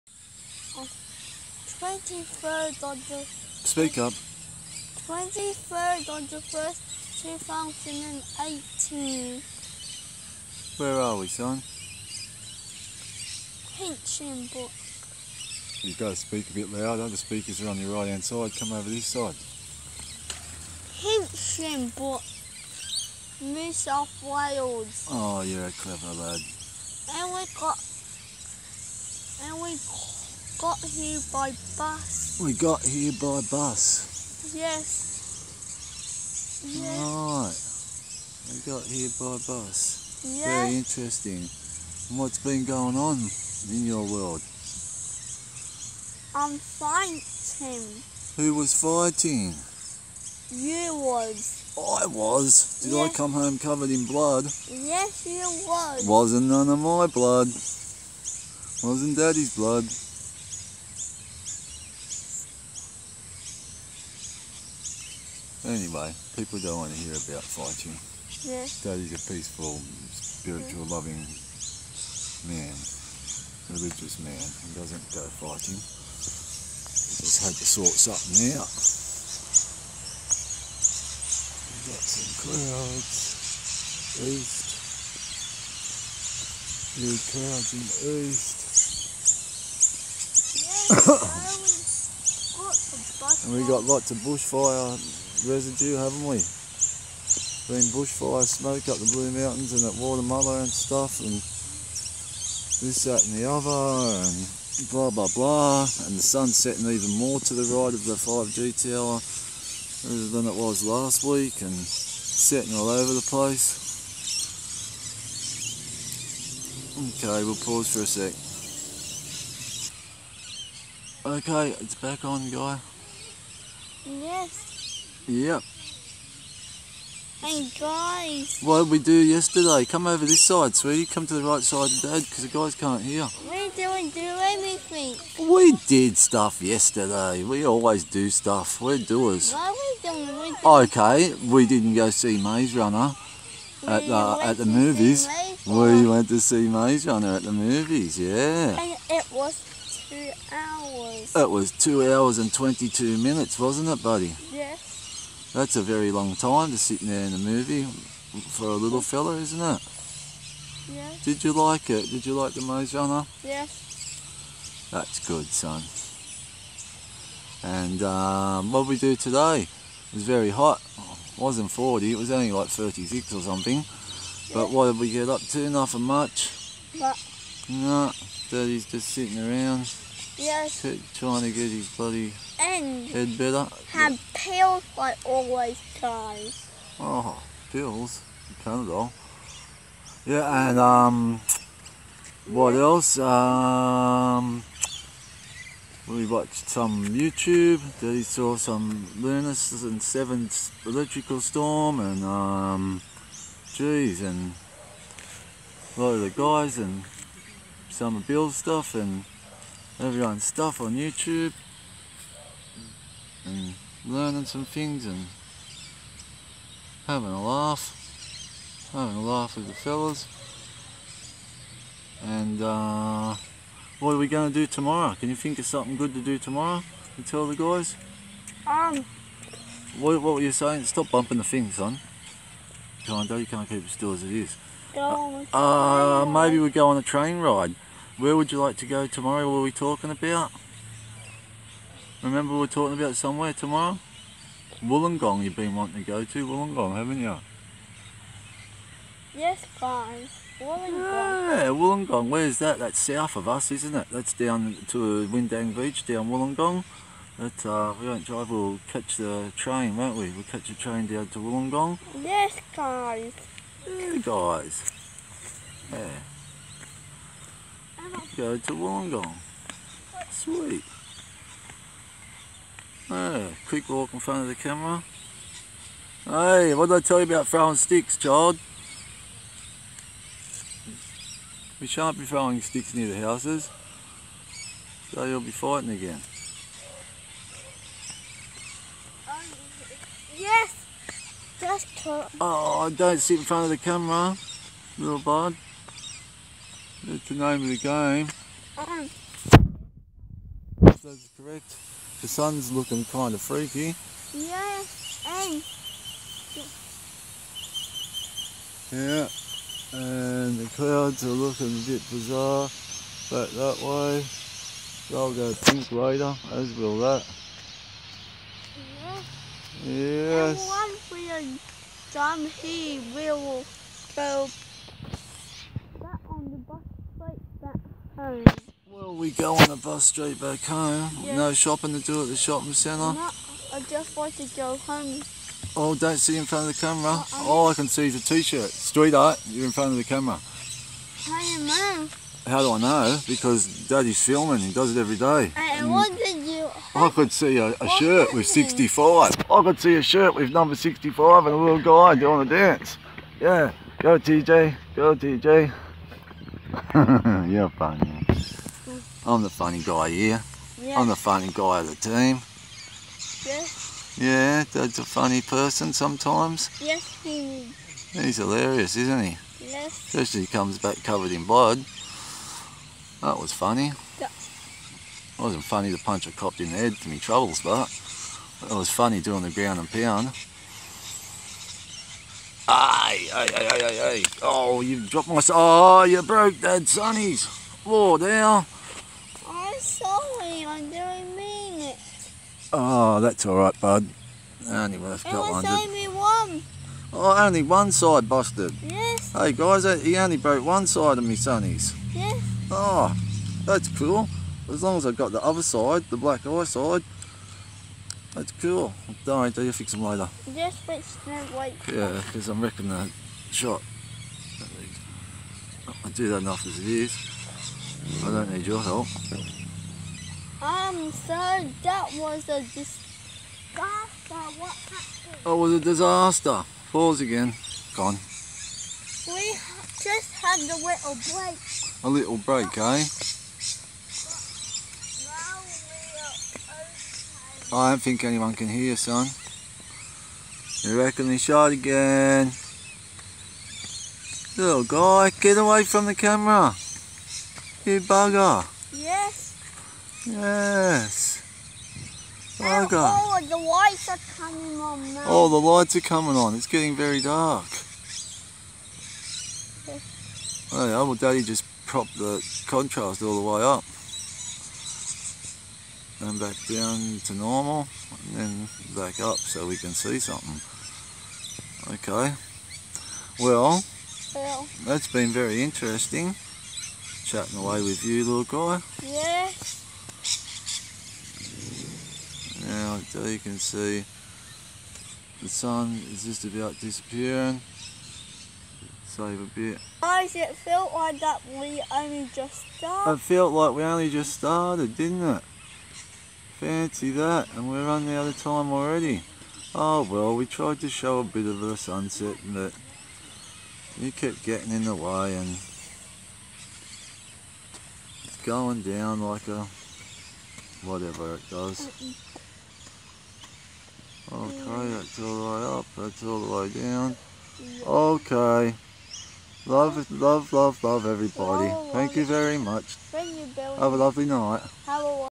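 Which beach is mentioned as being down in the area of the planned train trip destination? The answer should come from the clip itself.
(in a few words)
Windang Beach.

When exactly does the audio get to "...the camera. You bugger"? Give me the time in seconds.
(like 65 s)
446 s.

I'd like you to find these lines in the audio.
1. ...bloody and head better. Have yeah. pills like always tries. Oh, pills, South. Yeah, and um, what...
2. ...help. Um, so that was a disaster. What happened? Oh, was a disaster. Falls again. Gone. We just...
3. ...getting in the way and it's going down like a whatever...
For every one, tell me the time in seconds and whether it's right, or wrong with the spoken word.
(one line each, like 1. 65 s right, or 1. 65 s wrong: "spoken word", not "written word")
1. 181 s wrong: "Panadol", not "South"
2. 418 s right
3. 504 s right.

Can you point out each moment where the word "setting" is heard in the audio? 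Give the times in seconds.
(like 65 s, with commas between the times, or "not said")
106 s, 111 s.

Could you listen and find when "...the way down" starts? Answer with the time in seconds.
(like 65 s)
516 s.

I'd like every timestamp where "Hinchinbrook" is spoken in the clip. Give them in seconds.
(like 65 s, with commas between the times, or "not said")
13 s, 21 s.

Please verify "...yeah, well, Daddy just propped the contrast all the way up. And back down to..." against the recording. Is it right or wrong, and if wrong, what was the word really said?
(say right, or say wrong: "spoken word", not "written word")
right.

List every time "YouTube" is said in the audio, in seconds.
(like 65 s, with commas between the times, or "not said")
197 s, 210 s.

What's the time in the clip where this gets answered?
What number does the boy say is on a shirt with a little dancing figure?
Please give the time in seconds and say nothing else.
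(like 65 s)
350 s.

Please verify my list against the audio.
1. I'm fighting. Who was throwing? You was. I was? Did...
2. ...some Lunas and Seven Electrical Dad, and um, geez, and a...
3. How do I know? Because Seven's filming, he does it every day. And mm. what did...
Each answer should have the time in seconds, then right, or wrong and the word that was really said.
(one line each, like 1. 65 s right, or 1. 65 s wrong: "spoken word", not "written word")
1. 46 s wrong: "fighting", not "throwing"
2. 198 s wrong: "Storm", not "Dad"
3. 342 s wrong: "Daddy", not "Seven".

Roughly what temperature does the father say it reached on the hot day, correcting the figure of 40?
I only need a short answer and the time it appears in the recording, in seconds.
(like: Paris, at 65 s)
36, at 172 s.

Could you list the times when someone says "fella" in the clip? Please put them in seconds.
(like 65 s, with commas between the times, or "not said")
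159 s, 219 s.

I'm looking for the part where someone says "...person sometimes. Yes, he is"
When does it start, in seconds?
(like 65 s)
365 s.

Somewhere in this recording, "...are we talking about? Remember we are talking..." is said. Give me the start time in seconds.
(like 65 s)
239 s.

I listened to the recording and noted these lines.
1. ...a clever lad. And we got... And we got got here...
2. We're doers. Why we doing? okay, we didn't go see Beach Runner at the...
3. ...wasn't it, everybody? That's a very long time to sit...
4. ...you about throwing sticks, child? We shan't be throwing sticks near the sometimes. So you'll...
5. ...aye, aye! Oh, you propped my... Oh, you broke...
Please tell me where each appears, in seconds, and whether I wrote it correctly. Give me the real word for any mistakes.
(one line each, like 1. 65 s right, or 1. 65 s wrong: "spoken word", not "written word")
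1. 25 s right
2. 138 s wrong: "Maze", not "Beach"
3. 153 s wrong: "buddy", not "everybody"
4. 277 s wrong: "houses", not "sometimes"
5. 383 s wrong: "dropped", not "propped".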